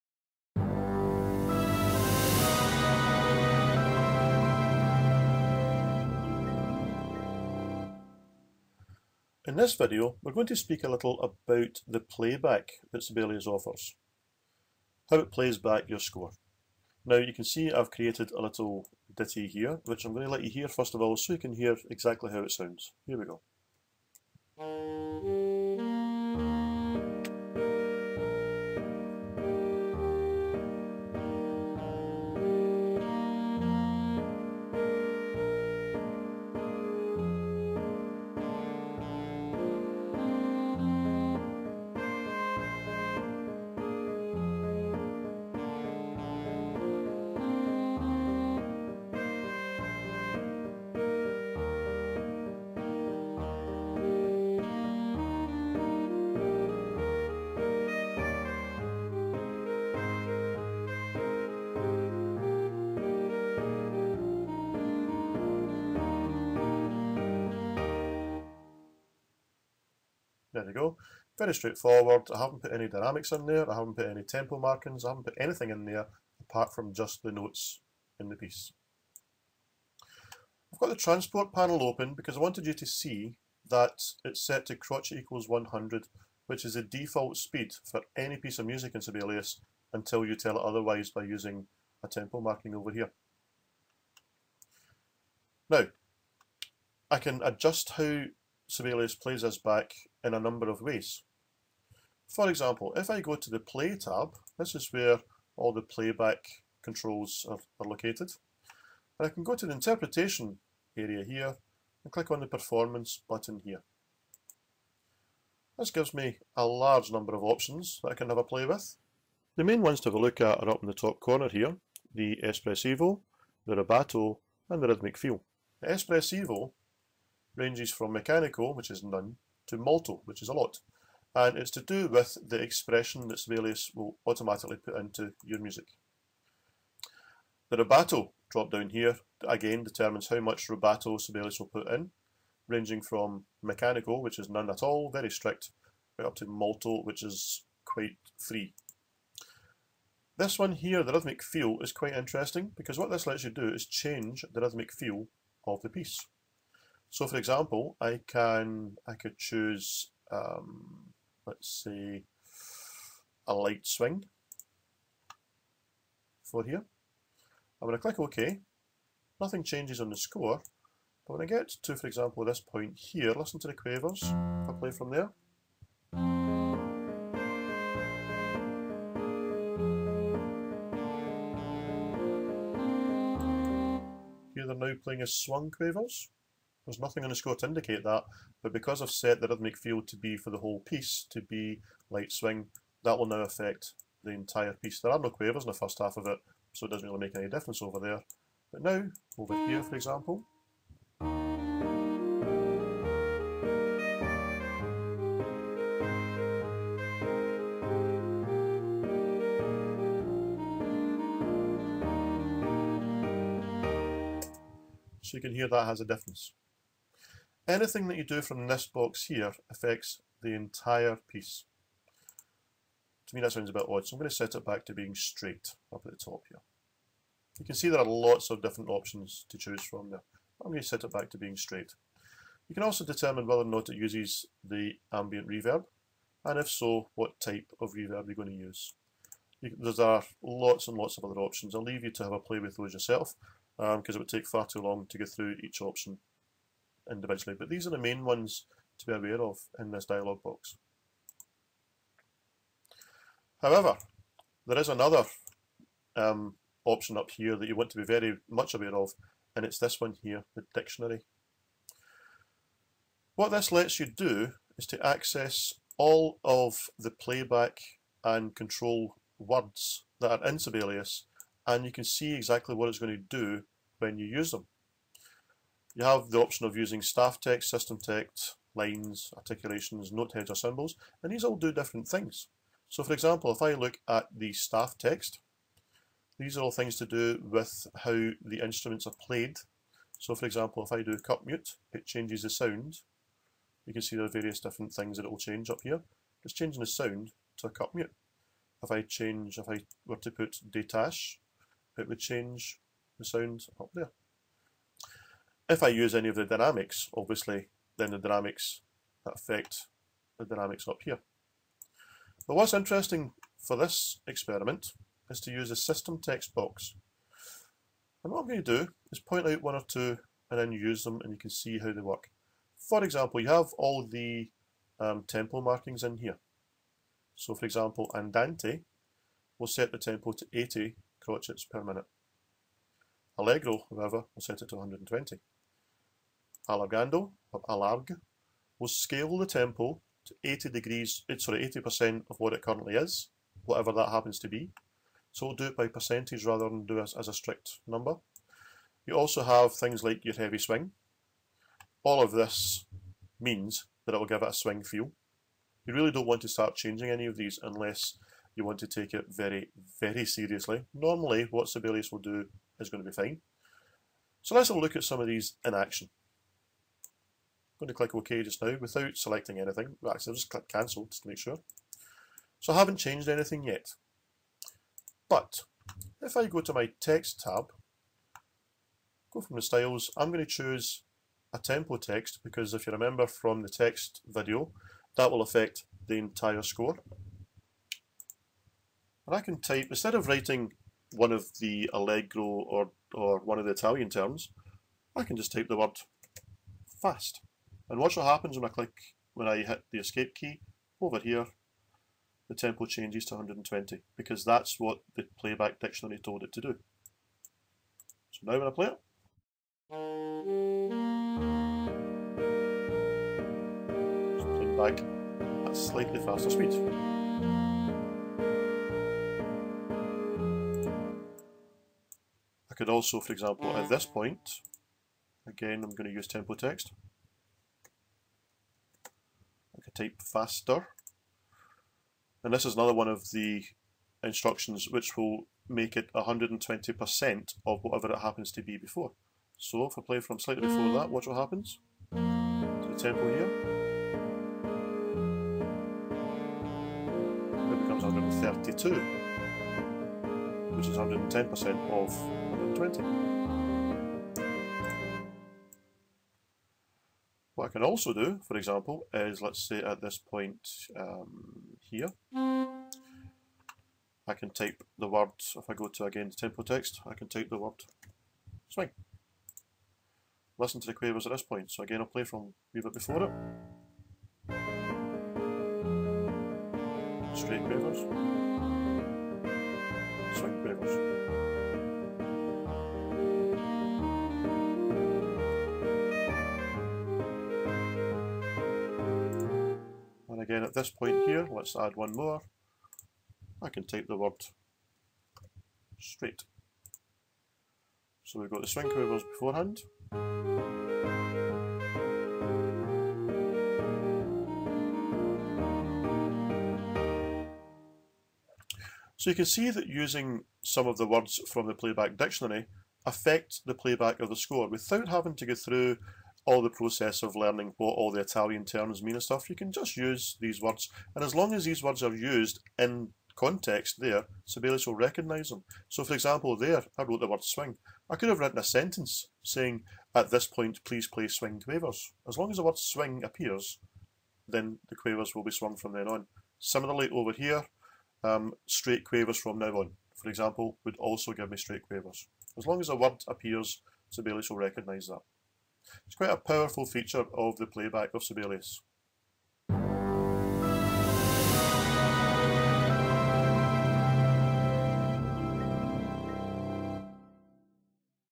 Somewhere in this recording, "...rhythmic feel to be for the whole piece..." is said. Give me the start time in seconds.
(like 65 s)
189 s.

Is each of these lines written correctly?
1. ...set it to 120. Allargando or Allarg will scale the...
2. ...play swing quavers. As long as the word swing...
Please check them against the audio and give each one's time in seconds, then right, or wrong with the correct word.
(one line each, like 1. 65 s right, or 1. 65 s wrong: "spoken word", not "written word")
1. 334 s right
2. 531 s right.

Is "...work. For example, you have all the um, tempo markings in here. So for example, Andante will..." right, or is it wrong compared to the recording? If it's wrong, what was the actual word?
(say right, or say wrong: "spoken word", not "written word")
right.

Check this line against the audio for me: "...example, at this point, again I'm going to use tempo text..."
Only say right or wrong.
right.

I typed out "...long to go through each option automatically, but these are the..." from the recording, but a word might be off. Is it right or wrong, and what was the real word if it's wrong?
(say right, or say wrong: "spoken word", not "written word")
wrong: "individually", not "automatically".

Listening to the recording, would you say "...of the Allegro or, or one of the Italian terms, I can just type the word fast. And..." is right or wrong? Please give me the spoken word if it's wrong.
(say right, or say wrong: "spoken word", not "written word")
right.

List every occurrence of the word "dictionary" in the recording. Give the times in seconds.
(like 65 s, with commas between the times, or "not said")
260 s, 405 s, 512 s.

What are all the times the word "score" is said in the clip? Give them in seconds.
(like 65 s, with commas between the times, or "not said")
15 s, 170 s, 187 s, 386 s, 514 s.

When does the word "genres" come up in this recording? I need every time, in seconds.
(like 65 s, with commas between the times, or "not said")
not said.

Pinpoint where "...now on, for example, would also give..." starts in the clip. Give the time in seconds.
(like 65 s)
539 s.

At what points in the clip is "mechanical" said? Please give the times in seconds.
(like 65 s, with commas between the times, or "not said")
128 s, 143 s.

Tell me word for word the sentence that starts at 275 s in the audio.
You have the option of using staff text, system text, lines, articulations, note heads or symbols, and these all do different things.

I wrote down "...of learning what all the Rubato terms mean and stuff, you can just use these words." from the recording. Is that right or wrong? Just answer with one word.
wrong.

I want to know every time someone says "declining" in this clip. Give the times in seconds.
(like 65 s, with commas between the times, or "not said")
not said.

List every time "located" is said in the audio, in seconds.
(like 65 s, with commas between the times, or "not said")
107 s.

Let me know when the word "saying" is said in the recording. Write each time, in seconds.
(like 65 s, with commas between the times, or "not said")
529 s.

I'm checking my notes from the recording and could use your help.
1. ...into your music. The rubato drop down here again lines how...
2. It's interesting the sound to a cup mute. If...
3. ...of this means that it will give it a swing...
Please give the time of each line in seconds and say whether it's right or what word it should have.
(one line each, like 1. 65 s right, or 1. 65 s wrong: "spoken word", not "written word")
1. 134 s wrong: "determines", not "lines"
2. 296 s wrong: "changing", not "interesting"
3. 352 s right.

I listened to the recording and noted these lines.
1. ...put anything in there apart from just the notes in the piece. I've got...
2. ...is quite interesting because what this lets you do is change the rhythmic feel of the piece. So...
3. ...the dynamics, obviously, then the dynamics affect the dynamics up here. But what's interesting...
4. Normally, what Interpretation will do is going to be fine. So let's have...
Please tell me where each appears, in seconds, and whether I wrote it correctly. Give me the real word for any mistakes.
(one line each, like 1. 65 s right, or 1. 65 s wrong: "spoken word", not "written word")
1. 75 s right
2. 151 s right
3. 306 s right
4. 360 s wrong: "Sibelius", not "Interpretation".